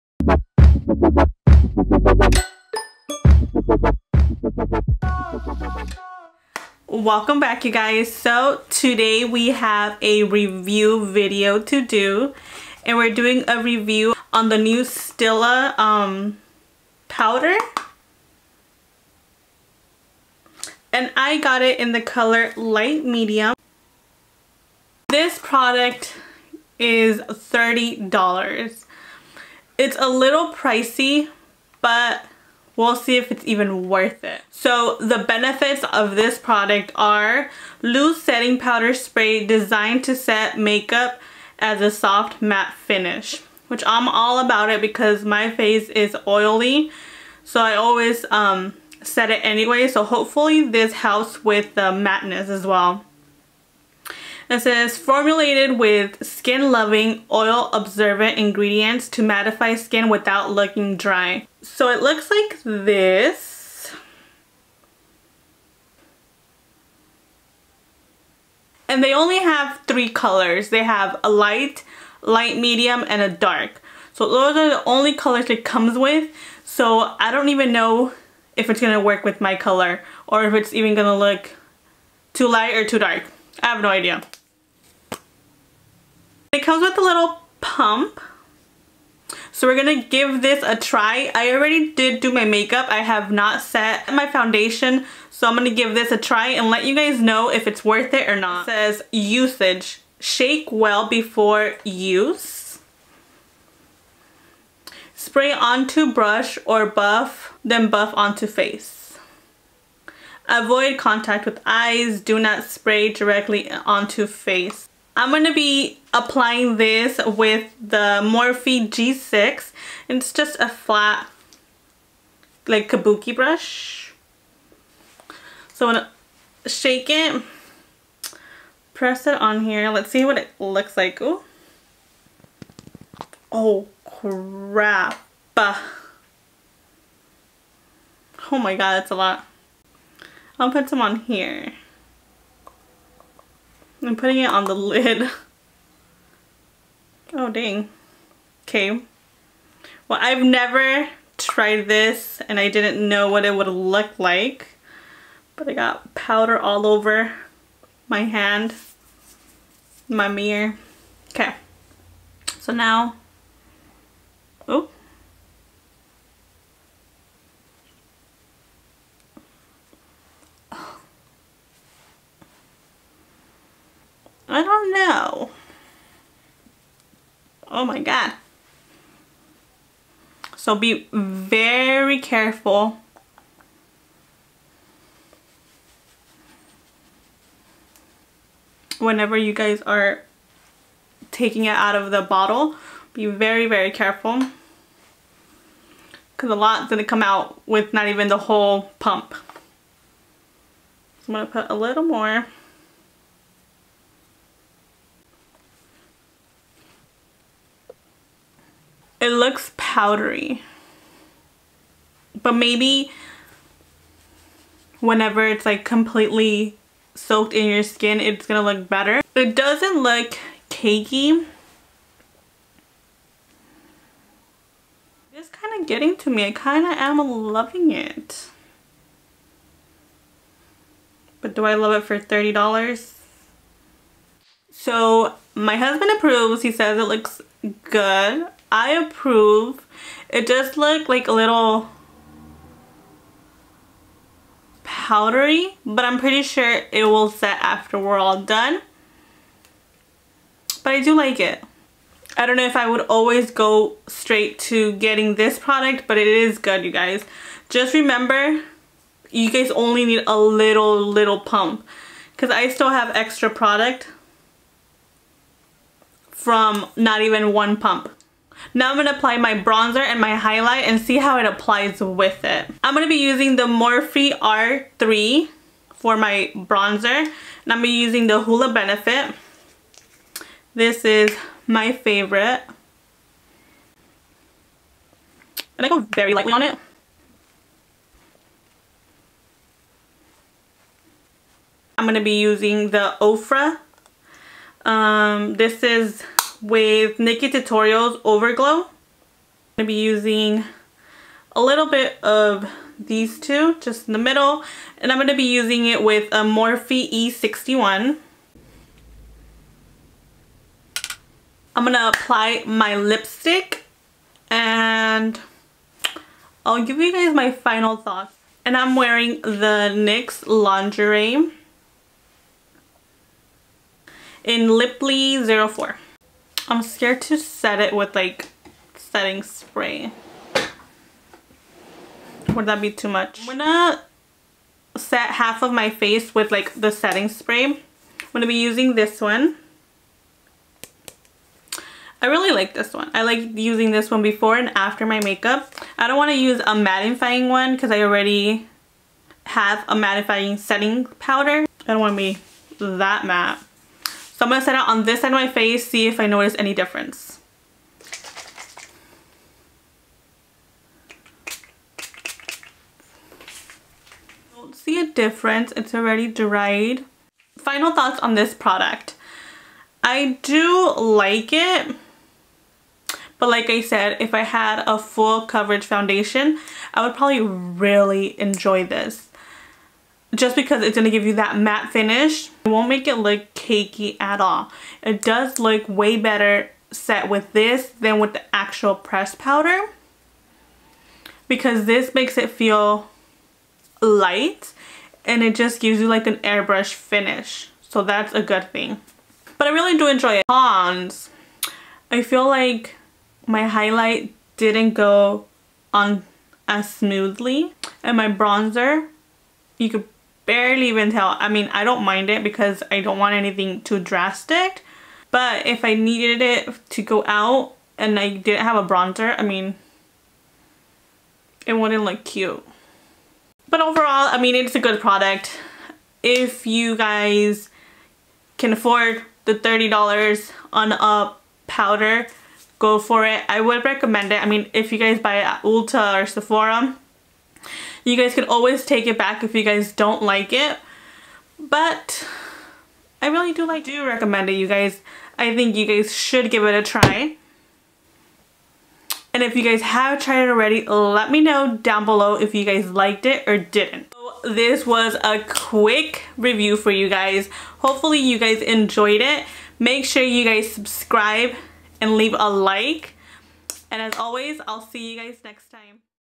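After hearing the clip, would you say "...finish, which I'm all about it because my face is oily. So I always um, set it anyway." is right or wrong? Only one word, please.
right.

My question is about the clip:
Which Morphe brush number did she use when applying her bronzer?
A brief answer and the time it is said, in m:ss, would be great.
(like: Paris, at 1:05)
R3, at 4:34.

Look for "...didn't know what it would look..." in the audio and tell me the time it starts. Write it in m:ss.
2:32.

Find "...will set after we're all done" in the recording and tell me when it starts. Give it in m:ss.
4:07.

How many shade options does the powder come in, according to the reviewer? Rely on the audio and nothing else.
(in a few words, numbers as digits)
3.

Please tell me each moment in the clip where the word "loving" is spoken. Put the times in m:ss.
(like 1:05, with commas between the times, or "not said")
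0:56, 3:47.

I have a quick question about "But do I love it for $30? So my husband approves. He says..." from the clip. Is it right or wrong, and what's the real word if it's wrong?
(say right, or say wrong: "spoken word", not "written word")
right.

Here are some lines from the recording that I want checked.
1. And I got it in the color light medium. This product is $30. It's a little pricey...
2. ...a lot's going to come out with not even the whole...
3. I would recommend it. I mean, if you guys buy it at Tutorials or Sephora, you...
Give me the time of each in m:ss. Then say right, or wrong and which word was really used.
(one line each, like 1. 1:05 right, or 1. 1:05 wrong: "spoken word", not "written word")
1. 0:20 right
2. 3:16 right
3. 7:13 wrong: "Ulta", not "Tutorials".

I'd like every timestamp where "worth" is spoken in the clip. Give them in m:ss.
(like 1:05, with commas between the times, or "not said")
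0:33, 1:37.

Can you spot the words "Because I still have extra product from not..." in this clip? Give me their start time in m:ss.
4:22.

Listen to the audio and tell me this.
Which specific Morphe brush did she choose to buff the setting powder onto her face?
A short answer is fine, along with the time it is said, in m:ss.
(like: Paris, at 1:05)
Morphe G6, at 1:58.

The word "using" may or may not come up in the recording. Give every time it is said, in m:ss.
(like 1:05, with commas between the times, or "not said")
4:33, 4:37, 4:52, 4:59, 5:05, 5:38, 5:43.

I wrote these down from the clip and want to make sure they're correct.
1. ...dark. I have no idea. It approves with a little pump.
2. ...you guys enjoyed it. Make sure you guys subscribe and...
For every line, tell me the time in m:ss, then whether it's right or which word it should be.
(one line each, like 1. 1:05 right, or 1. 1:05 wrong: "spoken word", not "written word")
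1. 1:22 wrong: "comes", not "approves"
2. 7:38 right.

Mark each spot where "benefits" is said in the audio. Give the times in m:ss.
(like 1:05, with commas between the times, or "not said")
0:35, 4:38.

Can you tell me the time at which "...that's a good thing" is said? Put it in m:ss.
6:38.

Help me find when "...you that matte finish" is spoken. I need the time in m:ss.
6:21.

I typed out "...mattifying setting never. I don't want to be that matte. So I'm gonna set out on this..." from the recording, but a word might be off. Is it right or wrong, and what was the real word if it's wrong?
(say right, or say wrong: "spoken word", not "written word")
wrong: "powder", not "never".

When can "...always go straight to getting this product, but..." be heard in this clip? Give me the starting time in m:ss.
4:13.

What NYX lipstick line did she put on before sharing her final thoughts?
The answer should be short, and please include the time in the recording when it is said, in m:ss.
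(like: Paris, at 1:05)
Lingerie, at 5:20.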